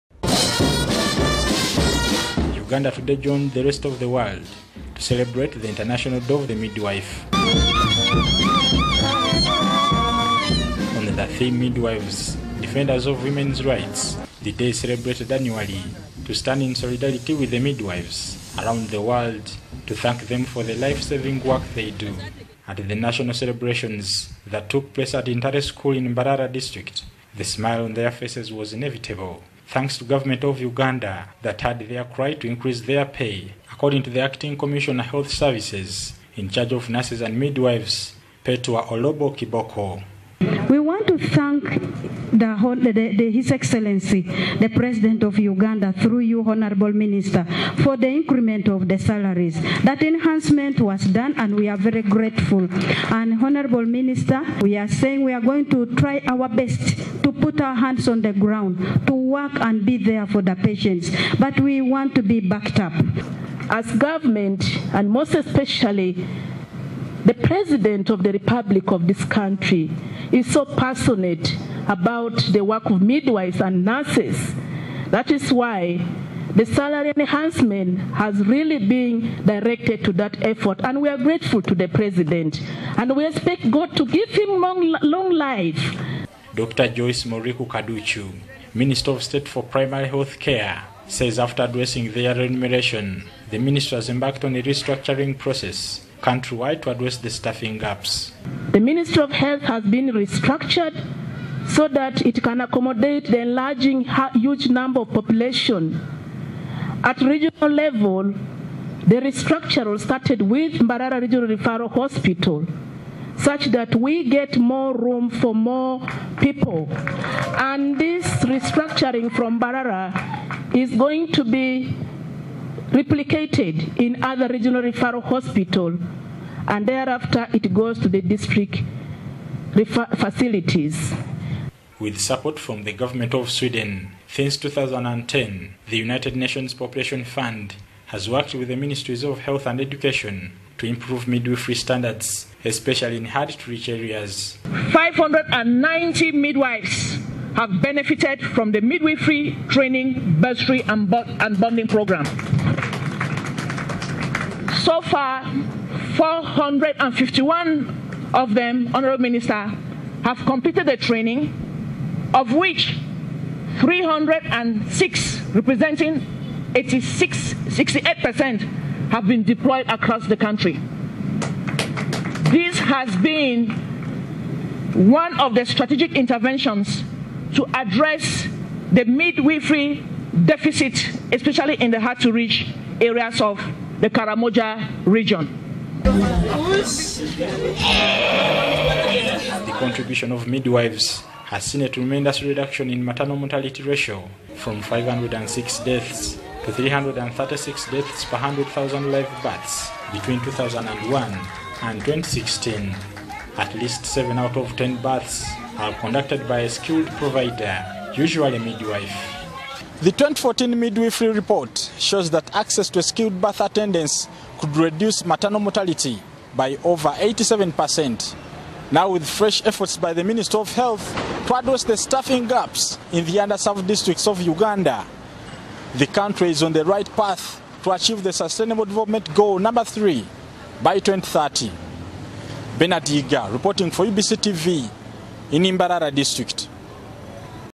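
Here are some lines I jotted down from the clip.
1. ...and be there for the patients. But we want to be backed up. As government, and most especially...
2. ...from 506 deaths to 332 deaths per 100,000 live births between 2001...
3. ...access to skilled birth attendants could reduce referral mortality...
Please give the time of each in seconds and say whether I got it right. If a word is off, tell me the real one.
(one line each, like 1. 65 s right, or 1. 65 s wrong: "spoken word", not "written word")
1. 59 s right
2. 194 s wrong: "336", not "332"
3. 212 s wrong: "maternal", not "referral".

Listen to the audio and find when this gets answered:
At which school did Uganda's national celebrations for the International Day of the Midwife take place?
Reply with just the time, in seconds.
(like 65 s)
25 s.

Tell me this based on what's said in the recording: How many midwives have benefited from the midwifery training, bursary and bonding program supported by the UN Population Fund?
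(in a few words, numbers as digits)
590.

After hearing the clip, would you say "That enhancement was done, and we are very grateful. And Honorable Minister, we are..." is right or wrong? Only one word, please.
right.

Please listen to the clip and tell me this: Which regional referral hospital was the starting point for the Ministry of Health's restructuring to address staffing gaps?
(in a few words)
Mbarara Regional Referral Hospital.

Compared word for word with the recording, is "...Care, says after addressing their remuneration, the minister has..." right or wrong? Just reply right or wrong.
right.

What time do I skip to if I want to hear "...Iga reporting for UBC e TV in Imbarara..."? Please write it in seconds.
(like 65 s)
233 s.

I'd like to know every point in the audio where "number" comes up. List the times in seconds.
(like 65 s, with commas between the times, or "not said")
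104 s, 229 s.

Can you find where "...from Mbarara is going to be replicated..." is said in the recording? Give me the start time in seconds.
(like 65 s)
119 s.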